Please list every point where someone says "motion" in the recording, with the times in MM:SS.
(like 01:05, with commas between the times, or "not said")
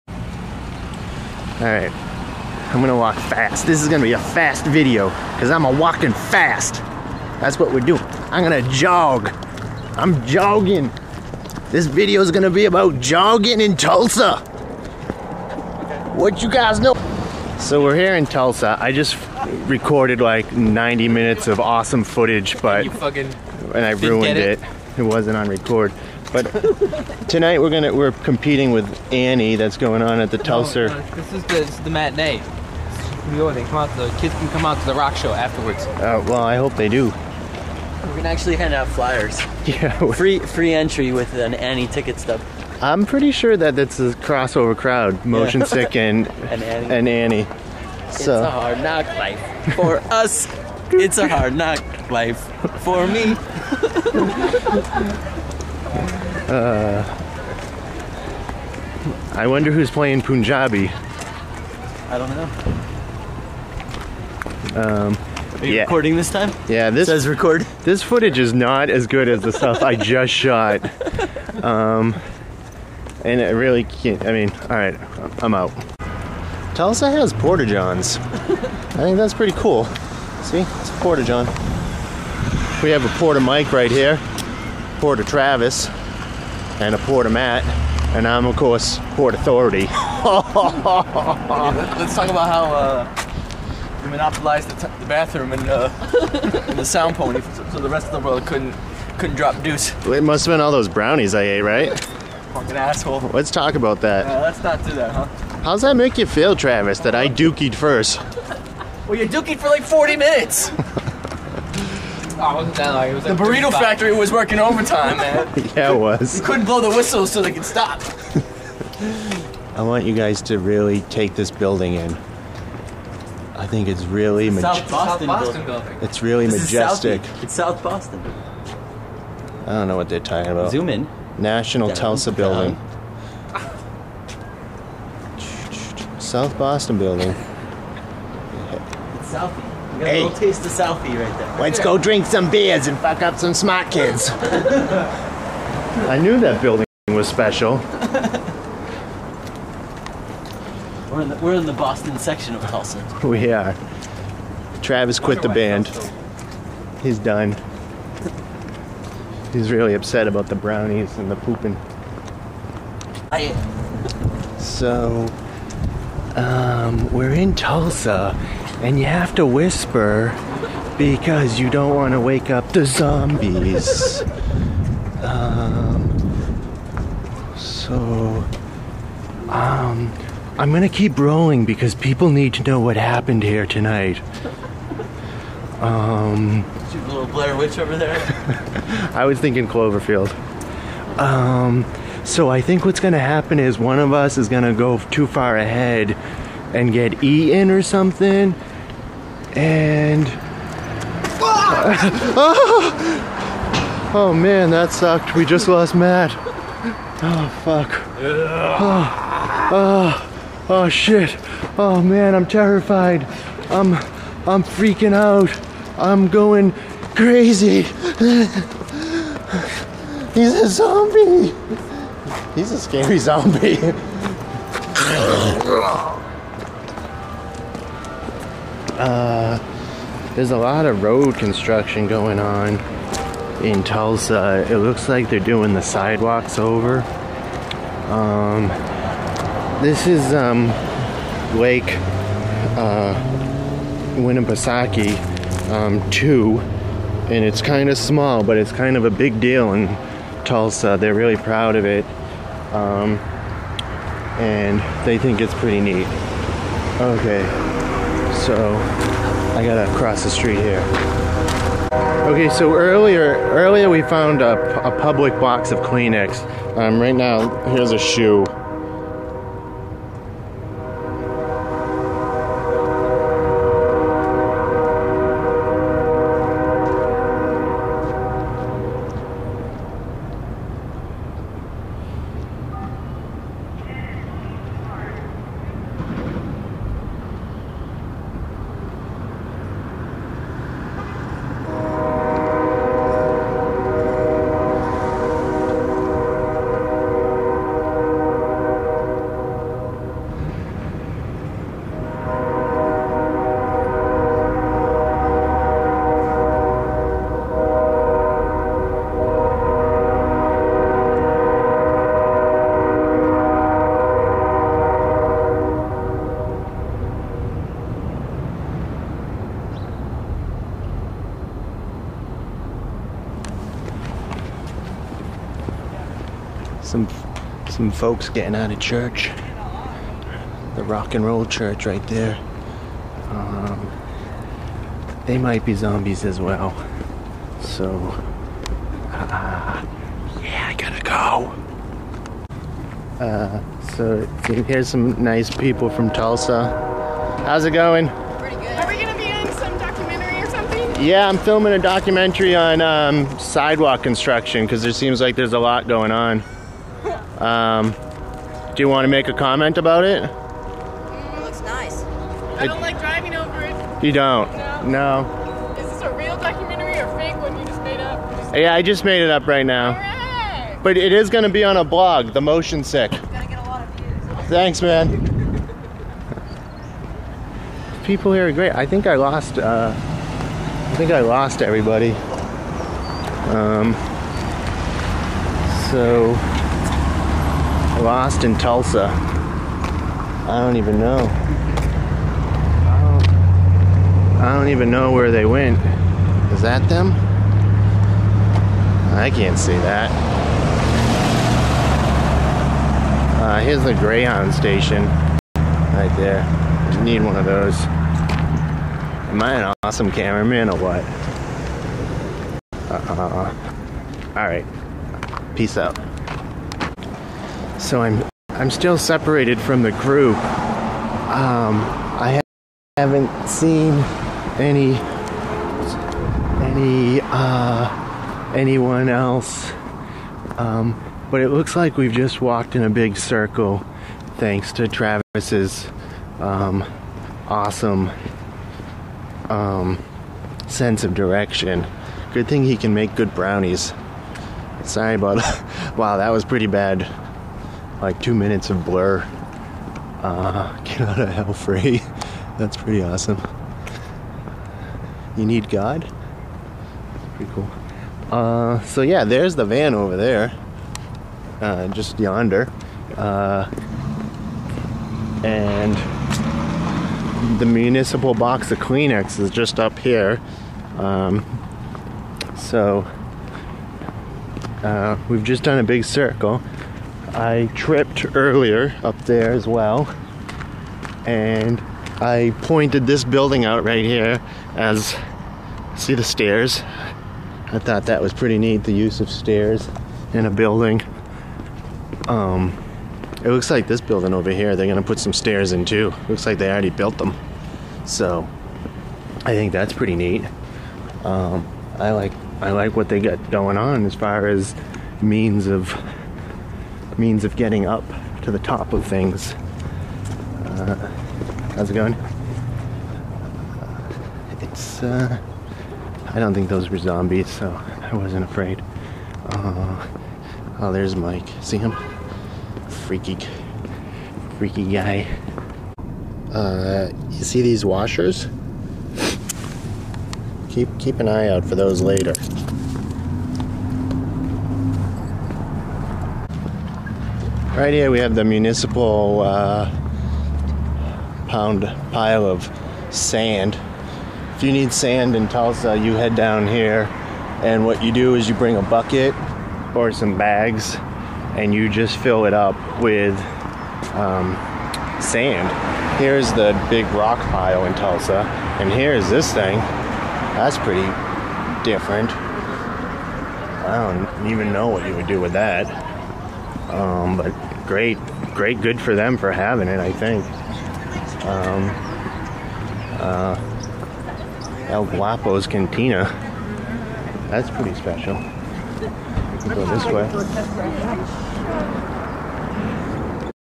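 00:45, 06:12.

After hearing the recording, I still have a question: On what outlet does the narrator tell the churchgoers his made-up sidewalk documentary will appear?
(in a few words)
A blog.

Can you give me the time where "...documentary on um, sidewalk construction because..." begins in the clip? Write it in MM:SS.
05:51.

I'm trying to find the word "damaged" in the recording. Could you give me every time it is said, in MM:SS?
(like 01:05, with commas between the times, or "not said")
not said.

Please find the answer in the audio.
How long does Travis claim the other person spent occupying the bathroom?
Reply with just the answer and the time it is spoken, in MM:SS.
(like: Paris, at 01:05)
40 minutes, at 01:49.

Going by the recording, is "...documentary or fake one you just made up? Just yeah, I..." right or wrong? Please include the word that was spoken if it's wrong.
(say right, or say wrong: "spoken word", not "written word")
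right.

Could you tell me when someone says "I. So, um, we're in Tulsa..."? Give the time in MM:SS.
02:43.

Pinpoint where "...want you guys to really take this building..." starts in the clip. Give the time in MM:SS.
01:59.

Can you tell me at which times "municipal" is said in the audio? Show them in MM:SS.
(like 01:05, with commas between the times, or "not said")
07:47, 08:58.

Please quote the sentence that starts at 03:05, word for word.
Um, the little Blair Witch over there?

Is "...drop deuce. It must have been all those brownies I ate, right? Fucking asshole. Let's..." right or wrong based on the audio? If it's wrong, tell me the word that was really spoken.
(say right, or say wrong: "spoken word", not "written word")
right.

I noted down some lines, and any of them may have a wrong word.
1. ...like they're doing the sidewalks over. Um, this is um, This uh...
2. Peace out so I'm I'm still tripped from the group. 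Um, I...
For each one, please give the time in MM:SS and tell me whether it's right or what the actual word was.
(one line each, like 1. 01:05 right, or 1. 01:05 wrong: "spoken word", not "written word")
1. 03:55 wrong: "Lake", not "This"
2. 06:55 wrong: "separated", not "tripped".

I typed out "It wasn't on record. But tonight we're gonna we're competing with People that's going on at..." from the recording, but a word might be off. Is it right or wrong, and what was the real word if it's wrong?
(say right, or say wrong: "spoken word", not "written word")
wrong: "Annie", not "People".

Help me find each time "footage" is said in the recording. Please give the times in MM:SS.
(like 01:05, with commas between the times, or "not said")
00:22, 01:08.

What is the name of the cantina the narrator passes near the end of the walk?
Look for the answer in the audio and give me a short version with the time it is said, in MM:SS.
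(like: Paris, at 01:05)
El Guapo's Cantina, at 09:34.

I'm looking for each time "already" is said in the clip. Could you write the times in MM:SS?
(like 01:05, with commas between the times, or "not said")
08:16.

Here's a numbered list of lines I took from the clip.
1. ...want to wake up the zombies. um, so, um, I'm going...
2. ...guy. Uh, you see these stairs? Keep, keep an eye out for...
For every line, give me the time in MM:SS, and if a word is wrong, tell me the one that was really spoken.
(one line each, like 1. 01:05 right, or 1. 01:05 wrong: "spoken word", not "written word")
1. 02:51 right
2. 08:44 wrong: "washers", not "stairs".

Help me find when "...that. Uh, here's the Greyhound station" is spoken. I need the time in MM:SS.
06:39.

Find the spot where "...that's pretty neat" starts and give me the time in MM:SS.
08:19.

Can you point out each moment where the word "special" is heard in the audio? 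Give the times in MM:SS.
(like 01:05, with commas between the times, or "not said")
02:27, 09:37.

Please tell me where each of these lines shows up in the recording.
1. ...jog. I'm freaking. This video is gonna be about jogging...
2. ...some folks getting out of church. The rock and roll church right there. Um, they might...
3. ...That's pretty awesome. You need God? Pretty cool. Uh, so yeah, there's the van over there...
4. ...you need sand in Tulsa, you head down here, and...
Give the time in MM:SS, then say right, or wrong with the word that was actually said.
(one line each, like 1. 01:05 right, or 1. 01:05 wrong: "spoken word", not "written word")
1. 00:08 wrong: "jogging", not "freaking"
2. 05:27 right
3. 07:32 right
4. 09:04 right.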